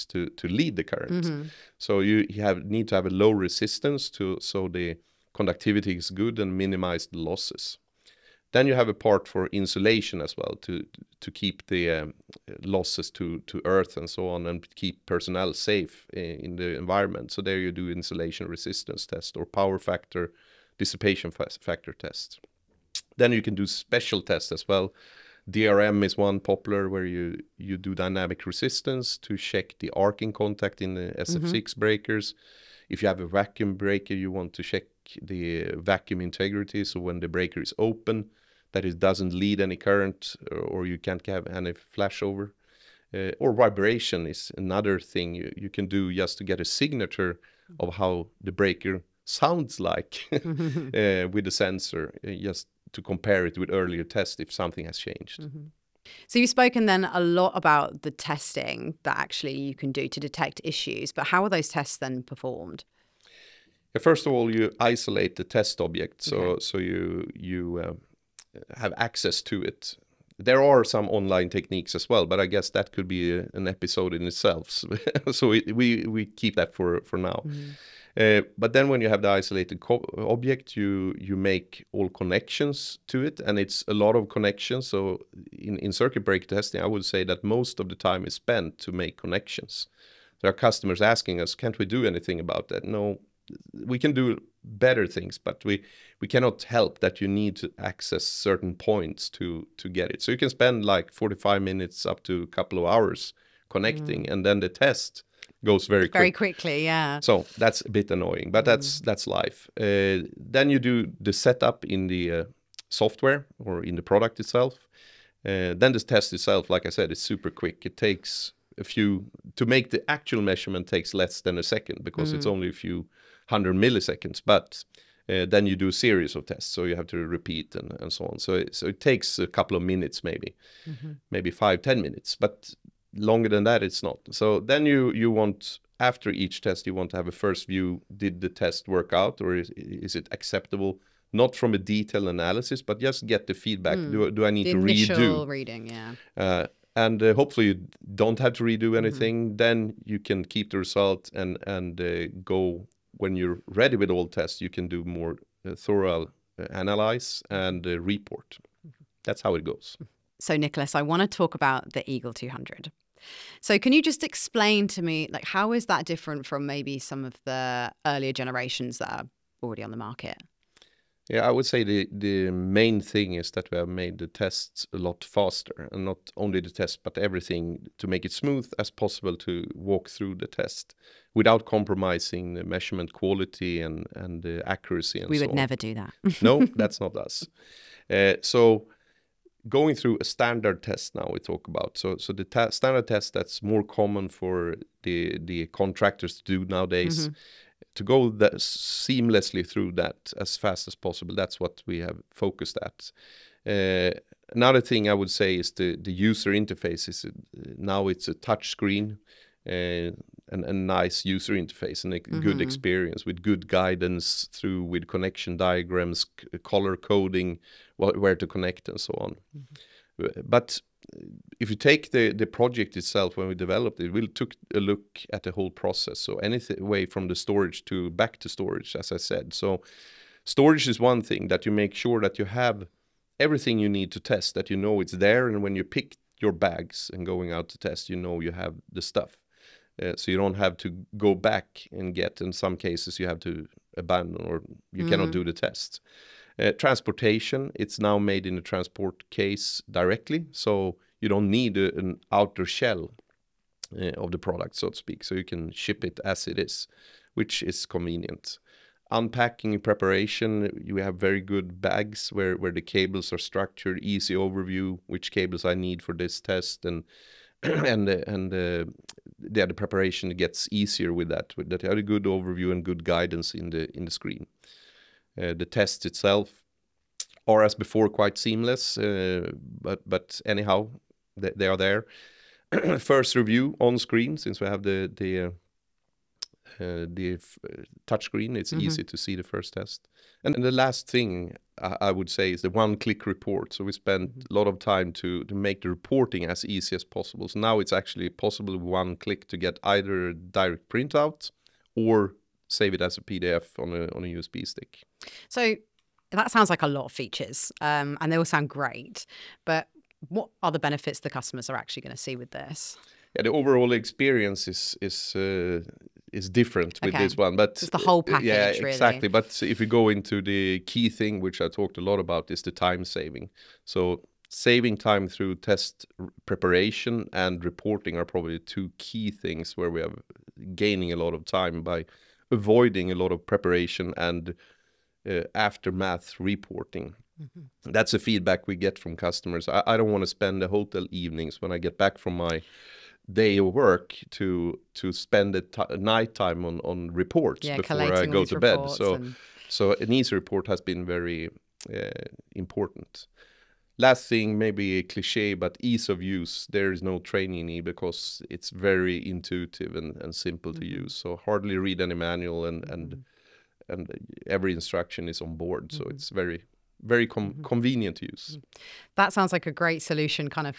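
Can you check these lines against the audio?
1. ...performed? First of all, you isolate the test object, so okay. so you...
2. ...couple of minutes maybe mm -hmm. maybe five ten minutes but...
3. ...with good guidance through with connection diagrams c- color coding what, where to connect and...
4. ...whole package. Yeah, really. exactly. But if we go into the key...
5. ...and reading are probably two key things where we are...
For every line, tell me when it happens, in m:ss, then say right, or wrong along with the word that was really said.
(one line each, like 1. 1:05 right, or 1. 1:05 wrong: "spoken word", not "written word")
1. 1:02 right
2. 2:09 right
3. 3:33 right
4. 5:17 right
5. 5:27 wrong: "reporting", not "reading".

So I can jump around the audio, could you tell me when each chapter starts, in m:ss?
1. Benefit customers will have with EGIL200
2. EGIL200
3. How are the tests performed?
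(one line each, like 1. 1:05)
1. 5:04
2. 2:39
3. 0:54.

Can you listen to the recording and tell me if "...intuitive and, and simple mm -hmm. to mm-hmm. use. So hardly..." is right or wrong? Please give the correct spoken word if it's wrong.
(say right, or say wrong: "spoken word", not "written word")
right.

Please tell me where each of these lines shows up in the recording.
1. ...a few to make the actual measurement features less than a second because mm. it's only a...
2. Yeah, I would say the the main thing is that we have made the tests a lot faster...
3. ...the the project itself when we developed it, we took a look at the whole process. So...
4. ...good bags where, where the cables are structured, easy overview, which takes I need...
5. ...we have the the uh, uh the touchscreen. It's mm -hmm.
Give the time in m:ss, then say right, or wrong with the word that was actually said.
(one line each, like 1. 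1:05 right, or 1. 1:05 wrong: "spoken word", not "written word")
1. 1:58 wrong: "takes", not "features"
2. 2:51 right
3. 3:42 right
4. 4:21 wrong: "cables", not "takes"
5. 4:44 right.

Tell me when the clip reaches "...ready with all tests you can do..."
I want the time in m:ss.
2:33.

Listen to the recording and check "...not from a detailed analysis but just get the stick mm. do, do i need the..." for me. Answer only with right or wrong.
wrong.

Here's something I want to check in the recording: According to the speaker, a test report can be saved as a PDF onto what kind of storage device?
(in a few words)
USB stick.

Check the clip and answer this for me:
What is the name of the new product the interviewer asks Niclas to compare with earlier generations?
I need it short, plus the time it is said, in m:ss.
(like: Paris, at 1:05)
EGIL 200, at 2:42.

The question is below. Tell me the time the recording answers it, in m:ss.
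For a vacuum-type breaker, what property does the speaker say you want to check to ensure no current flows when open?
0:35.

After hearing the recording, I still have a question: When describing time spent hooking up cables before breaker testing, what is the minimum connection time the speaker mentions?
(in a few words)
45 minutes.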